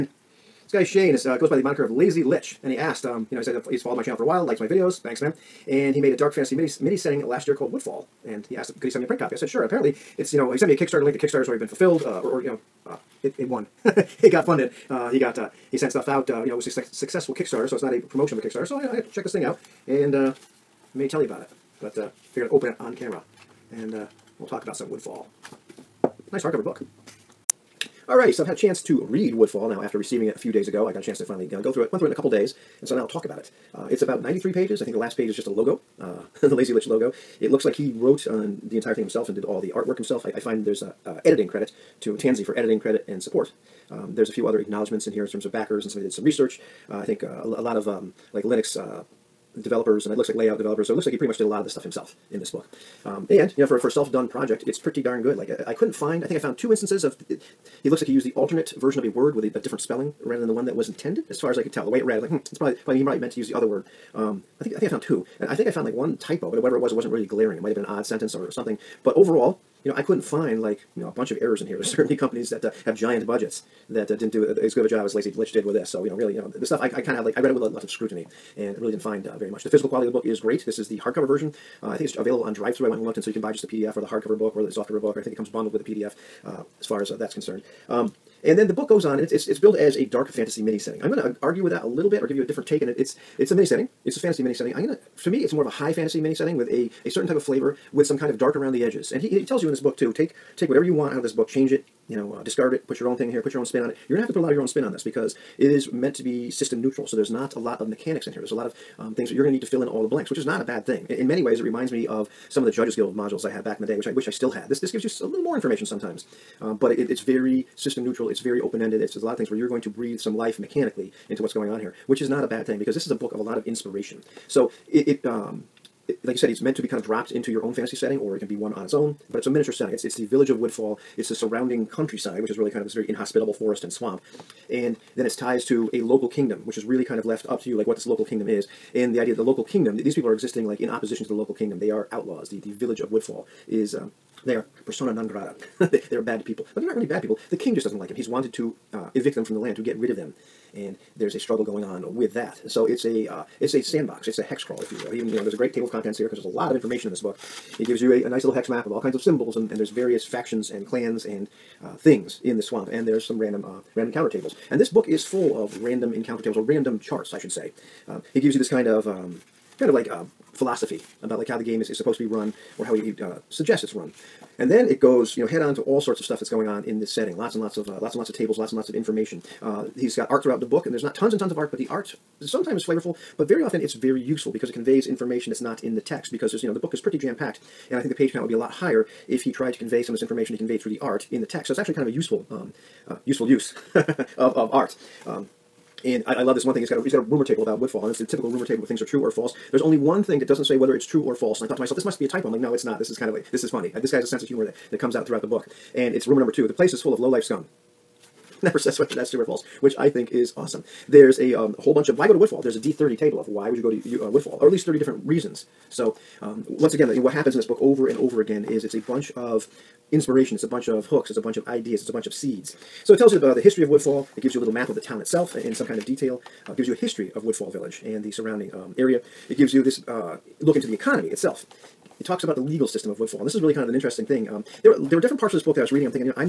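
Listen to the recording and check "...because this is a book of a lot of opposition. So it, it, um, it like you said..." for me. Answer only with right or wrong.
wrong.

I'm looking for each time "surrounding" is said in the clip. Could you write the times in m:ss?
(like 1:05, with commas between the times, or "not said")
2:11, 3:48.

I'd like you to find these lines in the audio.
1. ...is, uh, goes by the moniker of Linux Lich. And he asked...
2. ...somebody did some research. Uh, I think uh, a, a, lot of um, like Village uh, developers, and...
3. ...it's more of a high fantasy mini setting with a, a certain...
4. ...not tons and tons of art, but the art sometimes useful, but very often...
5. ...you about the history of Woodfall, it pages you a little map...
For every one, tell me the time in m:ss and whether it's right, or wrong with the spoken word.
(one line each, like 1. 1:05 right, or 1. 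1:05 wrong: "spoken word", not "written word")
1. 0:01 wrong: "Lazy", not "Linux"
2. 0:45 wrong: "Linux", not "Village"
3. 1:35 right
4. 3:01 wrong: "flavorful", not "useful"
5. 3:43 wrong: "gives", not "pages".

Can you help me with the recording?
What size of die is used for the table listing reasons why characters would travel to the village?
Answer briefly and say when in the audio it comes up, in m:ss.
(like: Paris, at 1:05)
D30, at 3:32.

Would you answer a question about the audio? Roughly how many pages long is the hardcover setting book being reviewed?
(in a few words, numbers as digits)
93.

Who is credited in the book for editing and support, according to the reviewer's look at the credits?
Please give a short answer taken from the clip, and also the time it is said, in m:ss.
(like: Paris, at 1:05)
Tansy, at 0:42.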